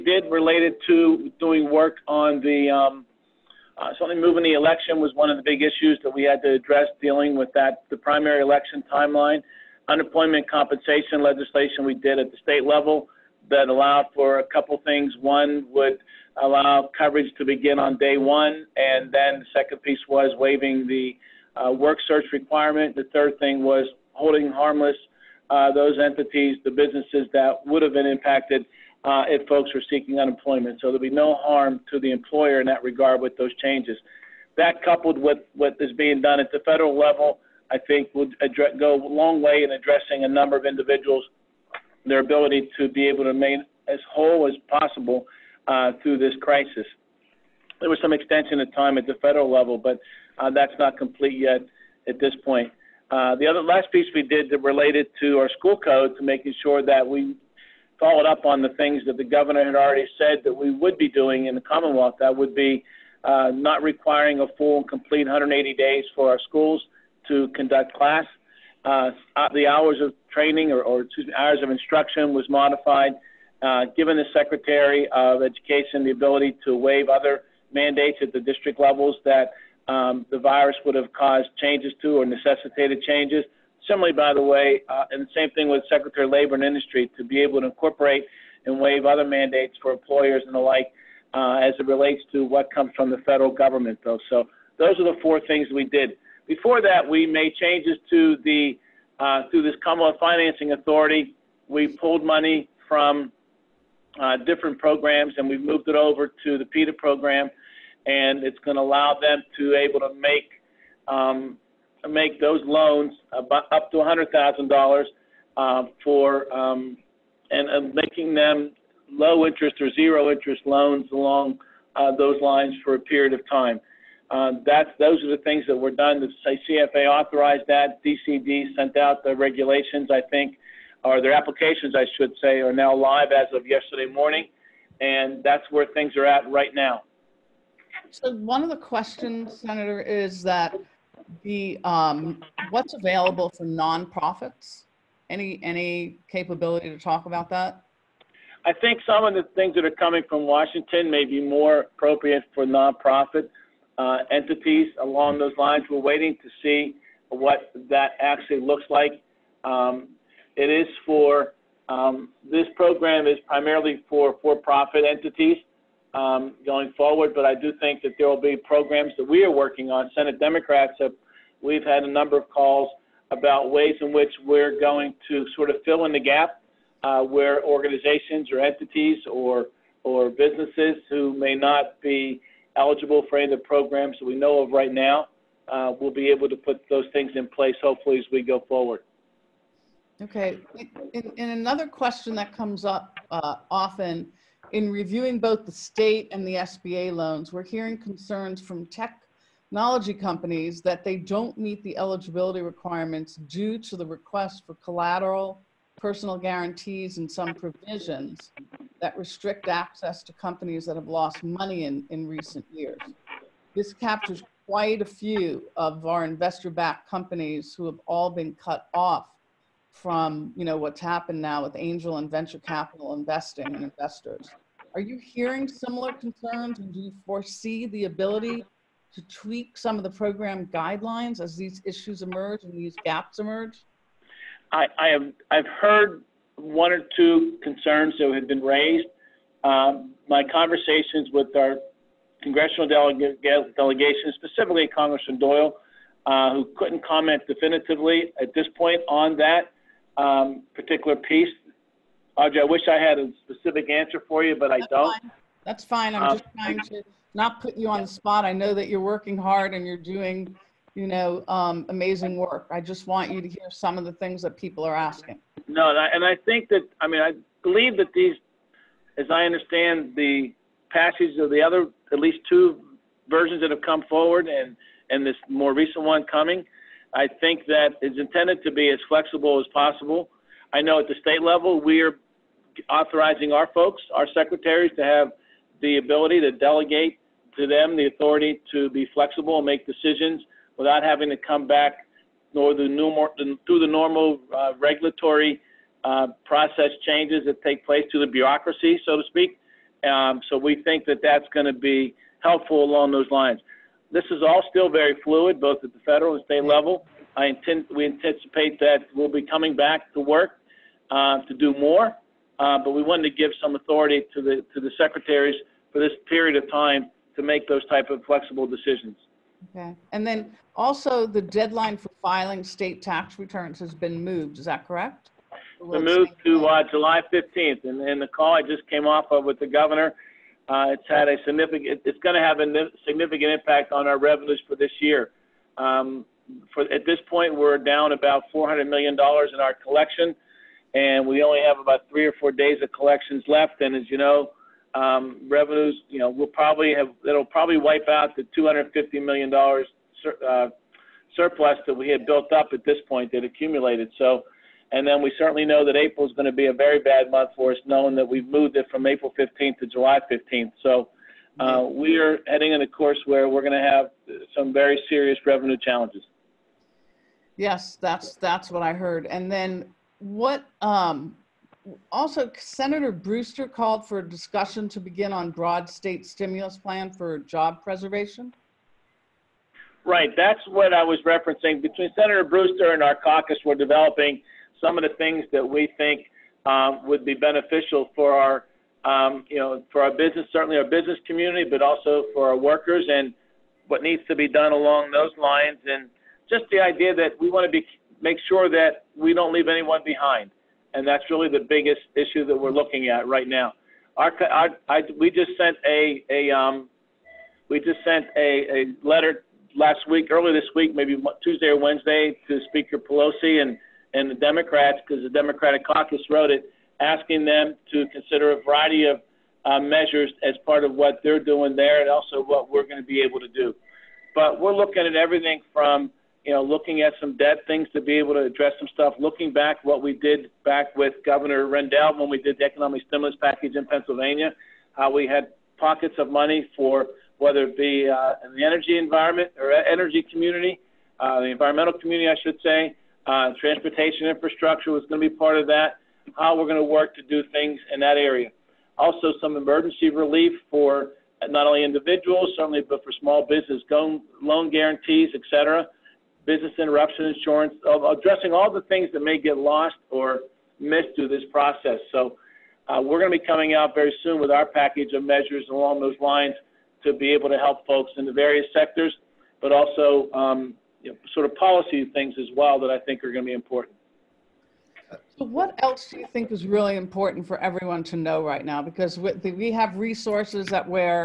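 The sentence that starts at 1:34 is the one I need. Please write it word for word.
So those are the four things we did.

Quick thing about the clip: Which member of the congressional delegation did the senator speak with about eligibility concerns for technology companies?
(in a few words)
Congressman Doyle.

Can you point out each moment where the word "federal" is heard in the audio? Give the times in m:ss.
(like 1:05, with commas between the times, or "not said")
0:36, 0:49, 1:33, 5:06.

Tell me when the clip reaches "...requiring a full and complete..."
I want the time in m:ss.
1:03.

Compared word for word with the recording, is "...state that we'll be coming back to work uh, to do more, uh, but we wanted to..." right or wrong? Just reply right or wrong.
wrong.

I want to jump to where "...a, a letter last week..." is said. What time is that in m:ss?
6:48.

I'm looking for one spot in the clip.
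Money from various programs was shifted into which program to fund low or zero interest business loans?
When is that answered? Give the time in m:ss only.
1:46.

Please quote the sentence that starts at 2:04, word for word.
Uh, that's those are the things that were done.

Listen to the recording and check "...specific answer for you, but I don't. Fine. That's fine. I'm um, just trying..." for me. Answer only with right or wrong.
right.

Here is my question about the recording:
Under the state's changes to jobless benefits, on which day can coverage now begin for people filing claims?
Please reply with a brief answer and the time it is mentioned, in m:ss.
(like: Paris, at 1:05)
Day one, at 0:17.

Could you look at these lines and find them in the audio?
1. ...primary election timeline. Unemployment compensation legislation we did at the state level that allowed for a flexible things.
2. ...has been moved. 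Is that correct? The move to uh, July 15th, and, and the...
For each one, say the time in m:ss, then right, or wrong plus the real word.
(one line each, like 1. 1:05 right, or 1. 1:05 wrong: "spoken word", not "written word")
1. 0:07 wrong: "couple", not "flexible"
2. 5:23 right.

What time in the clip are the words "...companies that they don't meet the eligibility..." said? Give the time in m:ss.
3:20.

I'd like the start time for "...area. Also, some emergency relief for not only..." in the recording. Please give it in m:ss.
7:28.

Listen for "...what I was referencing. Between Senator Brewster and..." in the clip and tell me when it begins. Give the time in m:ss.
6:20.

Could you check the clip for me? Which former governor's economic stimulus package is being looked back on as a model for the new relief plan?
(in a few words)
Governor Rendell.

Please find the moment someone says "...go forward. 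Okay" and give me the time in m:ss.
3:08.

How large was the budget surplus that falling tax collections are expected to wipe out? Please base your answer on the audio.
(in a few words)
250 million dollars.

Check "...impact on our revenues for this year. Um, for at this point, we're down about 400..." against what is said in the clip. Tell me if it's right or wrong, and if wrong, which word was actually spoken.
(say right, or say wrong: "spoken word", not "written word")
right.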